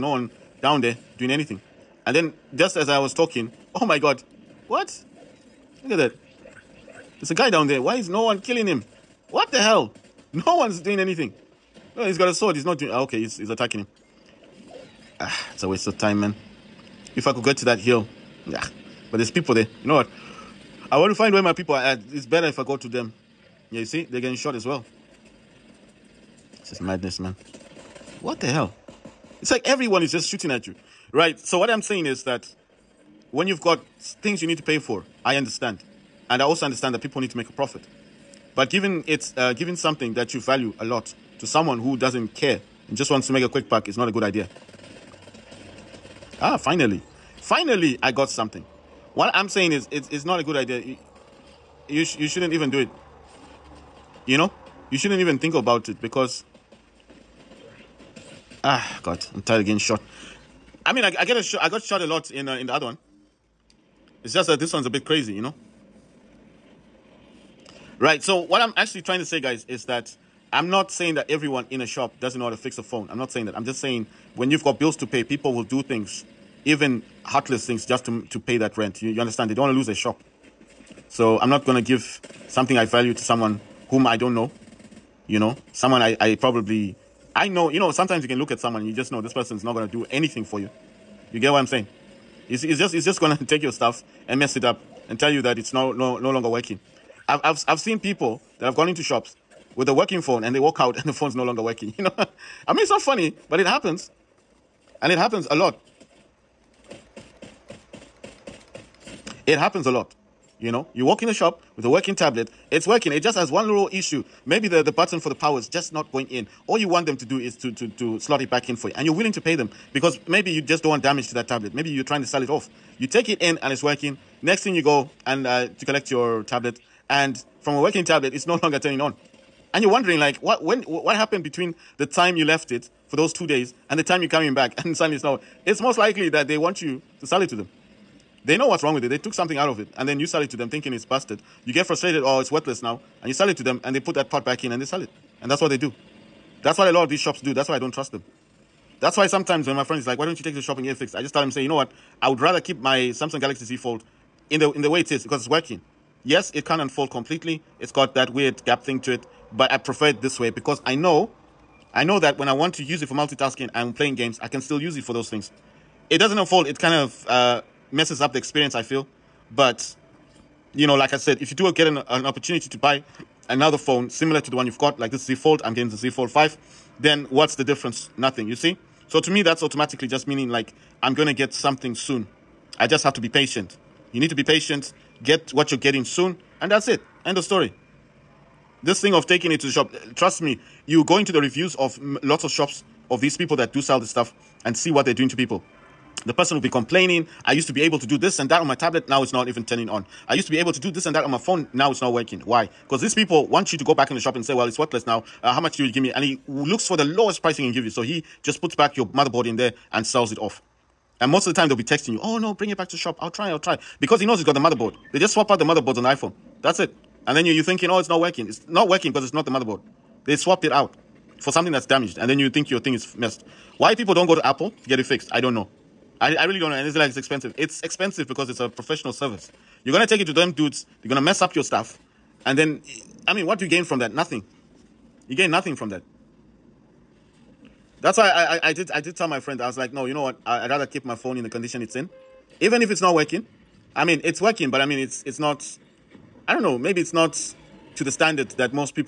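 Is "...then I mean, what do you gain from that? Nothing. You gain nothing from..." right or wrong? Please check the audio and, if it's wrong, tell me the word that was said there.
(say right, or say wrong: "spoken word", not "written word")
right.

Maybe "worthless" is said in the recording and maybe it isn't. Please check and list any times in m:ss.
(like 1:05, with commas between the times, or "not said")
2:22, 3:24.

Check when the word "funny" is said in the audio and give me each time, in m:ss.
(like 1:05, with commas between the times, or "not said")
1:43.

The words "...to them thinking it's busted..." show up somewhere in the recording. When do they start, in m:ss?
2:20.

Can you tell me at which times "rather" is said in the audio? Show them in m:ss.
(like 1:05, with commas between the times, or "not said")
2:32, 4:00.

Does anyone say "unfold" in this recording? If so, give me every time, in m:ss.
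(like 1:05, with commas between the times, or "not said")
2:36, 2:46.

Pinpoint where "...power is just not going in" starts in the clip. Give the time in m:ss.
1:55.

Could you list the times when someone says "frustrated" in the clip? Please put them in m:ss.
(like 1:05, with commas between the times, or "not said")
2:21.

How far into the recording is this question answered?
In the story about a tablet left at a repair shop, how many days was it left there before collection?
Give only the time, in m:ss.
2:13.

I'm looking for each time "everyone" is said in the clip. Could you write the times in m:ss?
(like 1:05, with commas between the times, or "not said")
0:29, 1:11.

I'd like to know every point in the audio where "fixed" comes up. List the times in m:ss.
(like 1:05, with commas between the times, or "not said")
2:30, 3:45.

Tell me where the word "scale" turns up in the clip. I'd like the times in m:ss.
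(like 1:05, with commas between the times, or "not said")
not said.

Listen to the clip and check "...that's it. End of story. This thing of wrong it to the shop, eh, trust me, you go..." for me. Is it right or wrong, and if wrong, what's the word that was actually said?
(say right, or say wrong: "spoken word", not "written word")
wrong: "taking", not "wrong".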